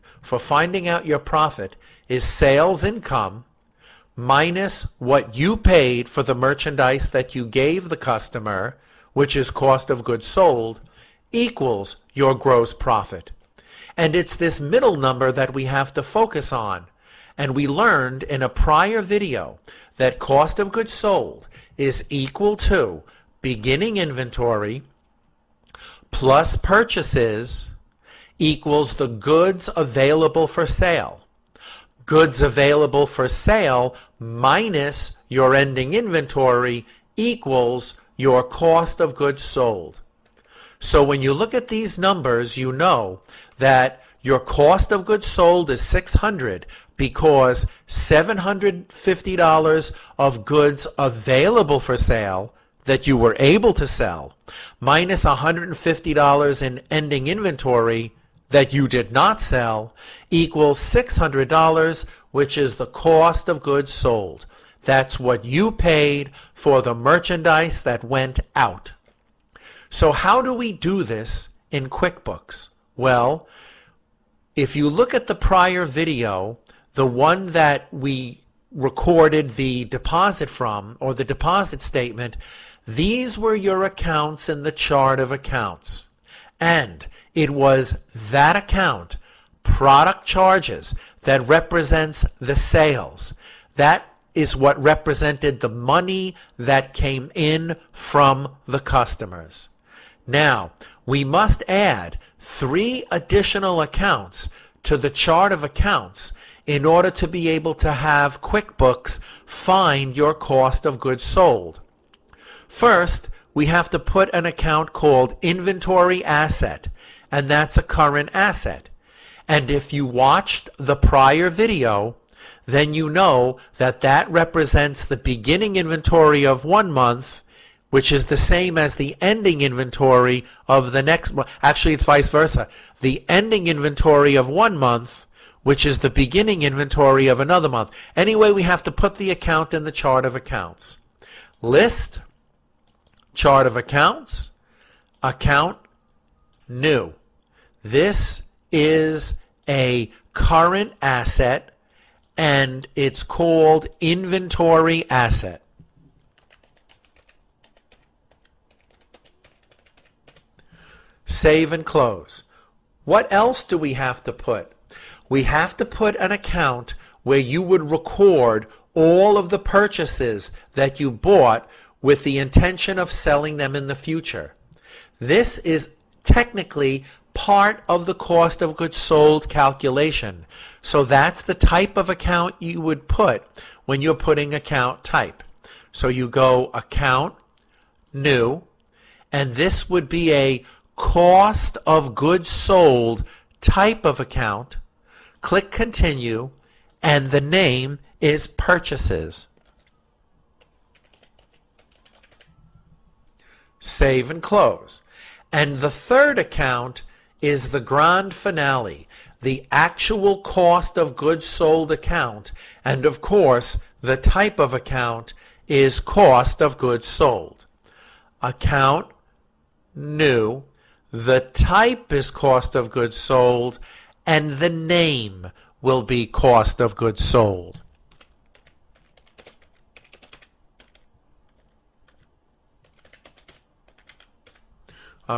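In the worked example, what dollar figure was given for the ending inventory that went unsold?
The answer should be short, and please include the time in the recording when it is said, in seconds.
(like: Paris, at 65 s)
$150, at 55 s.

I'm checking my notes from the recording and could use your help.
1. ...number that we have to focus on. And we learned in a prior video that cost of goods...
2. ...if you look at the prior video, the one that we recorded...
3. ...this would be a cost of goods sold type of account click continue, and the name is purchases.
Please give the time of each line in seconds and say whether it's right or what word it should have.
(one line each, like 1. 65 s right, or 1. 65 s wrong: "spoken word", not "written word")
1. 14 s right
2. 74 s right
3. 189 s right.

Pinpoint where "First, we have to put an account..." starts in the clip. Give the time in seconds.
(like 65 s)
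112 s.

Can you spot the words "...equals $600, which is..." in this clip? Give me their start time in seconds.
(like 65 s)
60 s.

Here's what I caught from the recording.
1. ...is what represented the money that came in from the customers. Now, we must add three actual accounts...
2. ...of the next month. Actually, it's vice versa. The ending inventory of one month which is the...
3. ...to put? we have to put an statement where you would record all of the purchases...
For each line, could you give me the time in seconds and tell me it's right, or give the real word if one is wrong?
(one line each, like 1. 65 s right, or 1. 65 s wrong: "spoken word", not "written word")
1. 94 s wrong: "additional", not "actual"
2. 130 s right
3. 164 s wrong: "account", not "statement".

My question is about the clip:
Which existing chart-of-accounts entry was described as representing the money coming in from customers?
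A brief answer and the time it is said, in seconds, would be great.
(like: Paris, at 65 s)
Product charges, at 89 s.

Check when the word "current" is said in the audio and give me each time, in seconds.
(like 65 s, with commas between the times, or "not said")
117 s, 150 s.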